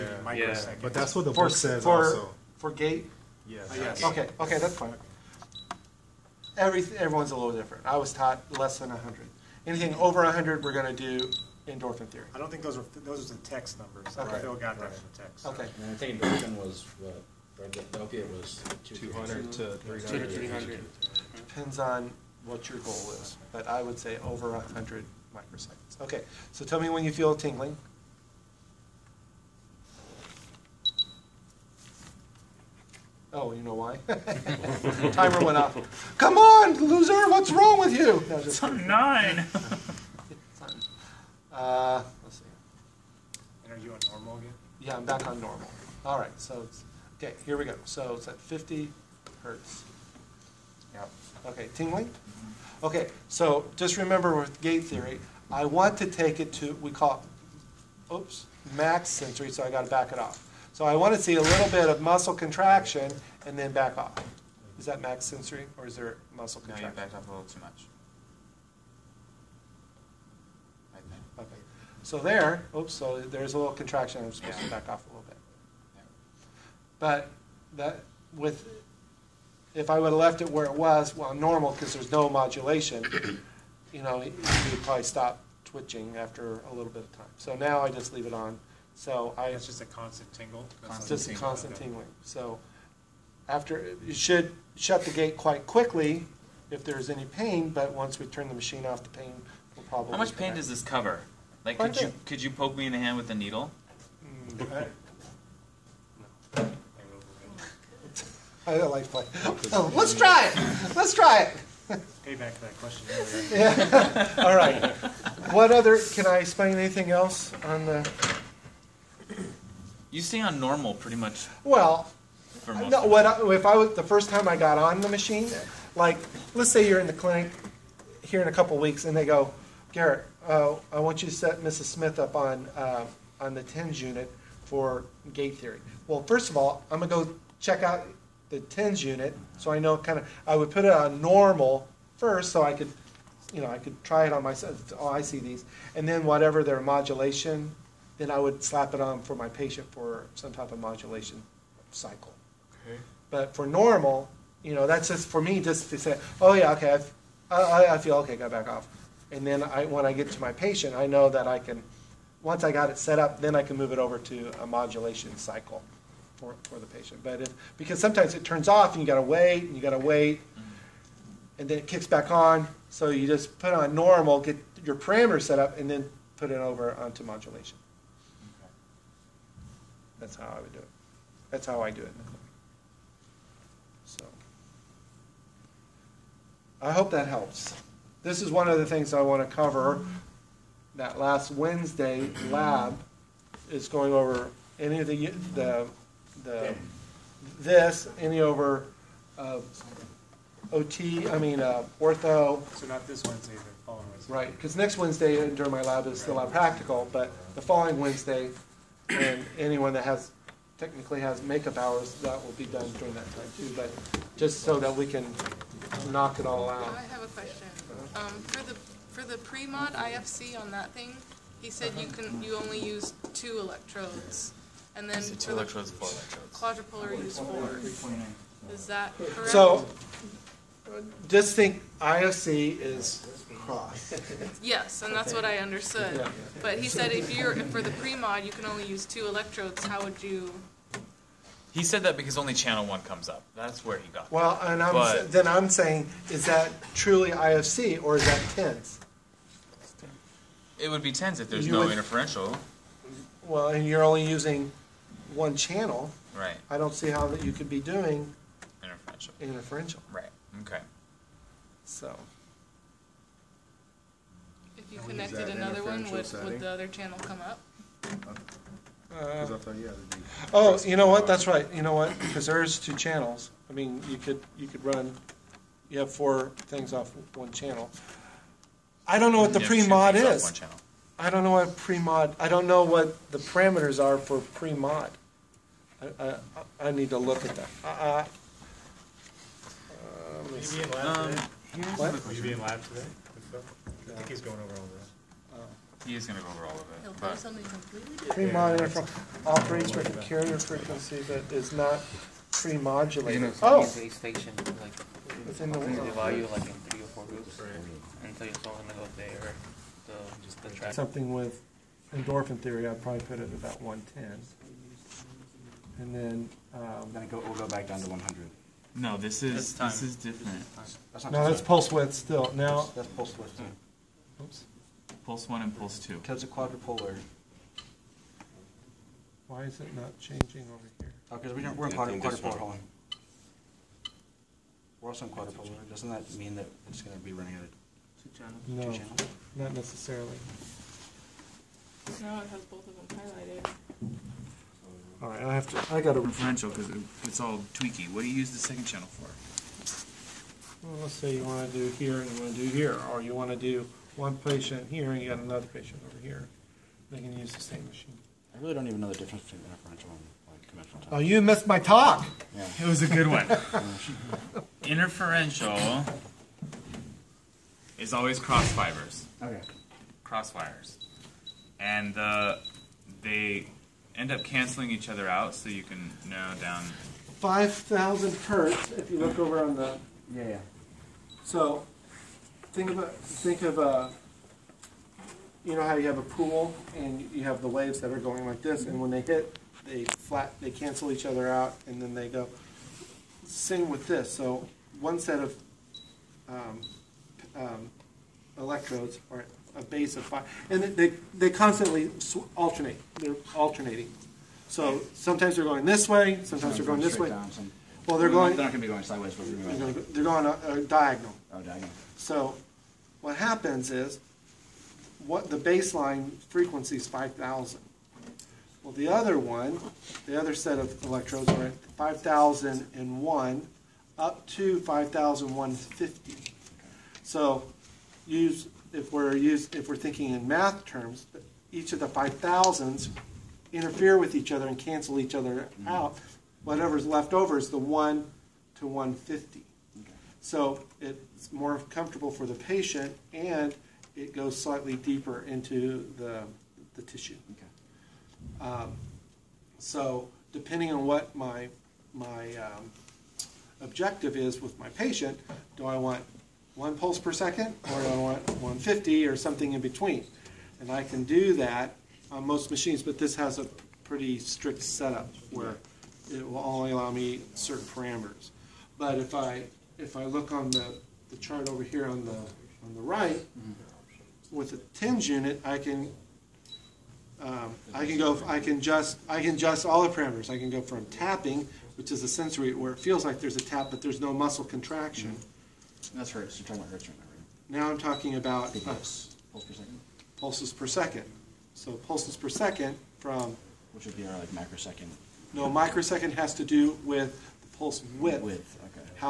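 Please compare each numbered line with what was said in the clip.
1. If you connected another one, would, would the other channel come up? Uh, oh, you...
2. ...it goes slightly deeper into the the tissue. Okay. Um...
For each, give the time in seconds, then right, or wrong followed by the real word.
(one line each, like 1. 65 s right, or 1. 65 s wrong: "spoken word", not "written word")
1. 264 s right
2. 444 s right.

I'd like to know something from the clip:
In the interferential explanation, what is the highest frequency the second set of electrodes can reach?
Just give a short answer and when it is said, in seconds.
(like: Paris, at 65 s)
5,150, at 424 s.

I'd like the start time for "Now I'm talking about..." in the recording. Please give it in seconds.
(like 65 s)
487 s.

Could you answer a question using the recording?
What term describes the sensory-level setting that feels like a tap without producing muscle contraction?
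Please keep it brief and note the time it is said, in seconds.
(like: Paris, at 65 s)
tapping, at 481 s.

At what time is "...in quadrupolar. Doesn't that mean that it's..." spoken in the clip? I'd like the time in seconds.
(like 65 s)
335 s.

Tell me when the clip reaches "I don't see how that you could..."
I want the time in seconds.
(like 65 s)
256 s.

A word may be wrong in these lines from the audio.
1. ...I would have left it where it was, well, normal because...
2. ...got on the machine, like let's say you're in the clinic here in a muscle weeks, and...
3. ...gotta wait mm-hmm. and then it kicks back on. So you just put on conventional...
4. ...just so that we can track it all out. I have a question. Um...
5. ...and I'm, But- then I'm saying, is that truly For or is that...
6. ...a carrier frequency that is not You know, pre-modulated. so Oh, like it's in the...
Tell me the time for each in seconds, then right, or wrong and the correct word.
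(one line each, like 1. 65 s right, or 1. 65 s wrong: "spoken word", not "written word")
1. 79 s right
2. 124 s wrong: "couple", not "muscle"
3. 169 s wrong: "normal", not "conventional"
4. 214 s wrong: "knock", not "track"
5. 244 s wrong: "IFC", not "For"
6. 300 s right.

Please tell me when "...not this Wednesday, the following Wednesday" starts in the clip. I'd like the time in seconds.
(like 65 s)
202 s.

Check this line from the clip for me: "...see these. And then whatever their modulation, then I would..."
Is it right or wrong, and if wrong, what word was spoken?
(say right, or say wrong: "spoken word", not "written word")
right.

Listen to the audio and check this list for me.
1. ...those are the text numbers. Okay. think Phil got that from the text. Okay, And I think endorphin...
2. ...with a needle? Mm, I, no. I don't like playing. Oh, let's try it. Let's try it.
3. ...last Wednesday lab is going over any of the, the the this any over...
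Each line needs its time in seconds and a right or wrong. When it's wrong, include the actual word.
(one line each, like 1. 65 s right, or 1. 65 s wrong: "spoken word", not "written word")
1. 13 s right
2. 103 s right
3. 191 s right.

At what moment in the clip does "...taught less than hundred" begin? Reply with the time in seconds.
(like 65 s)
8 s.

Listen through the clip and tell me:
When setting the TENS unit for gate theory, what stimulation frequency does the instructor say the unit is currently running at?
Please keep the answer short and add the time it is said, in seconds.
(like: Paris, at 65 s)
50 hertz, at 48 s.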